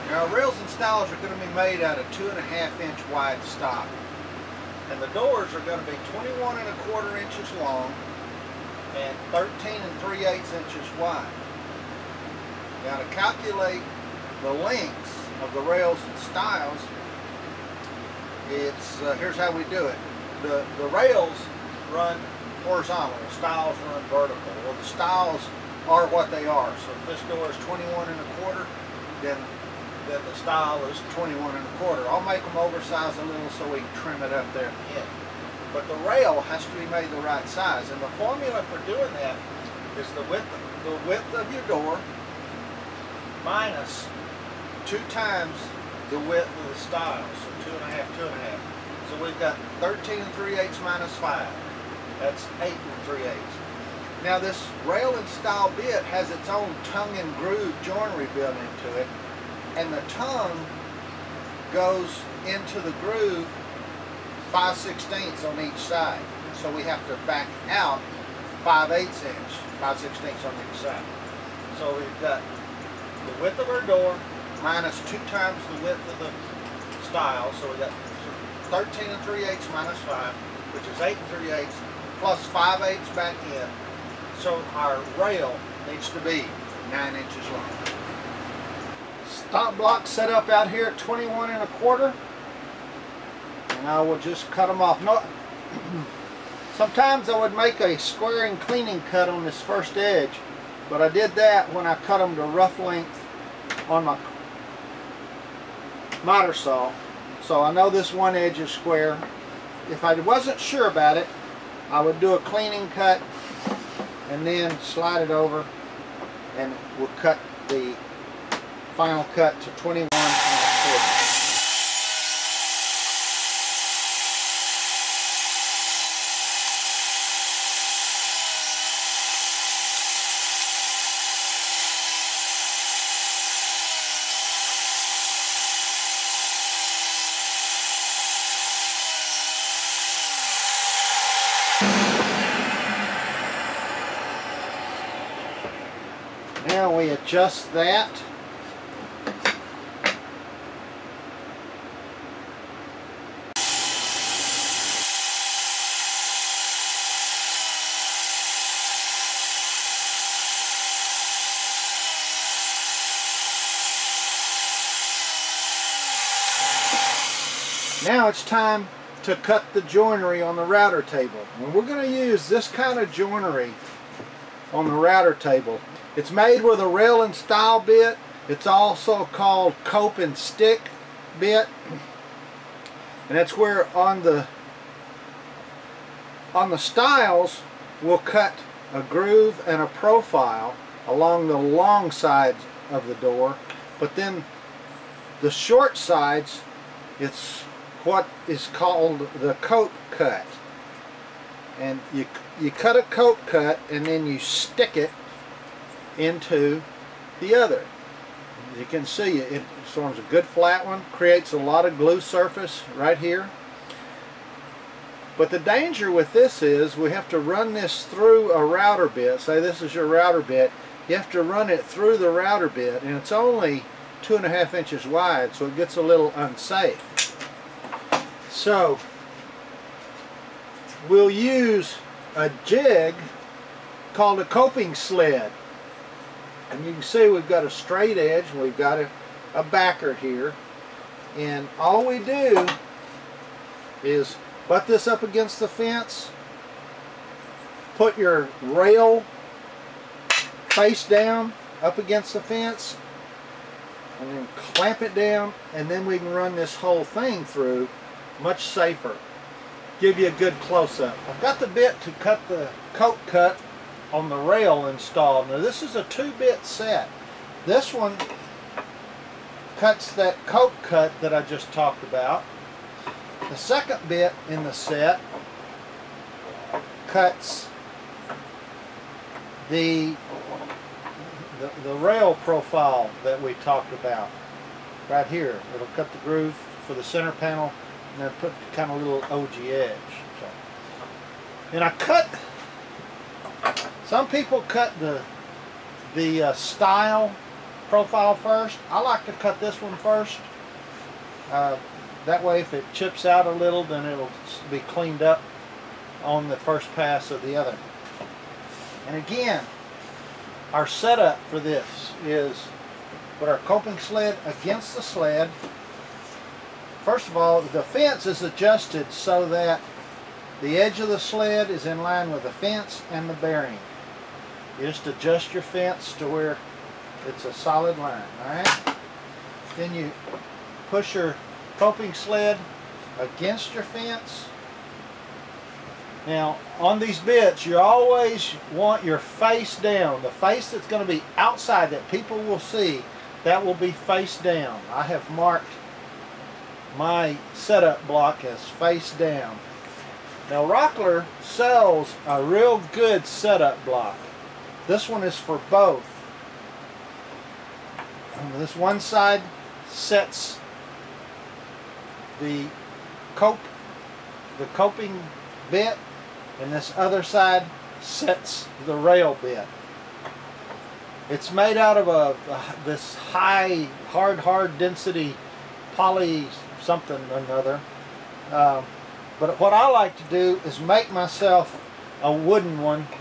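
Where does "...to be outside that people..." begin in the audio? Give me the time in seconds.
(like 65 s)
341 s.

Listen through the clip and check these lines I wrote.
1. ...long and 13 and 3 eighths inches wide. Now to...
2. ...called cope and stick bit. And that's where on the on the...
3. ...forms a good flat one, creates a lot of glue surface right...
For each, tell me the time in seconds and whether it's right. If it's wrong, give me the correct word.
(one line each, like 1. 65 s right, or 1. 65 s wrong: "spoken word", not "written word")
1. 7 s right
2. 179 s right
3. 209 s right.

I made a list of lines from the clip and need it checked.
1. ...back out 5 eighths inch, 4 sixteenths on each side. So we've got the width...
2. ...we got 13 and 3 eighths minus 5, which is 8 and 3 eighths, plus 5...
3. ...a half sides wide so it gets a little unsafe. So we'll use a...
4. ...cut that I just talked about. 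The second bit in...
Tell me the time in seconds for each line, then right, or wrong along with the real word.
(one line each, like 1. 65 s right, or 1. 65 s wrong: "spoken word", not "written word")
1. 67 s wrong: "5", not "4"
2. 77 s right
3. 224 s wrong: "inches", not "sides"
4. 270 s right.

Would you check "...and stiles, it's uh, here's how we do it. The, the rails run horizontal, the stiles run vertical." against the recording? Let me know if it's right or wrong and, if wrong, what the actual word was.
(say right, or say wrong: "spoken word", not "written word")
right.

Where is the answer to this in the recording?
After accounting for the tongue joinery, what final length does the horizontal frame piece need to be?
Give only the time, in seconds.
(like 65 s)
86 s.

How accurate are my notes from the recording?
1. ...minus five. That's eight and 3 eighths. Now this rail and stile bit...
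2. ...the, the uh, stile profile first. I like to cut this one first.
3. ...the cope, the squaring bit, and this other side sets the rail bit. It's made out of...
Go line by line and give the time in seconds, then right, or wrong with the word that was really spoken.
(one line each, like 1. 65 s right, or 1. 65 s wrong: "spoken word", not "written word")
1. 50 s right
2. 294 s right
3. 362 s wrong: "coping", not "squaring".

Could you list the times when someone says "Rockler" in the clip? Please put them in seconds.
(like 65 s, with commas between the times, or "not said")
350 s.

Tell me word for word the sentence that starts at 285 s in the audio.
It'll cut the groove for the center panel and I put kind of little ogee edge.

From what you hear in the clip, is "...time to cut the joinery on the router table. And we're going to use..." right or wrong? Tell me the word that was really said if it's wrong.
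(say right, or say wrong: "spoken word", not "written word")
right.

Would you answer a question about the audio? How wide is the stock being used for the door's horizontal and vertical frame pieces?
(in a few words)
2 1/2 inches.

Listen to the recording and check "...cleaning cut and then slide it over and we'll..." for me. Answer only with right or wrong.
right.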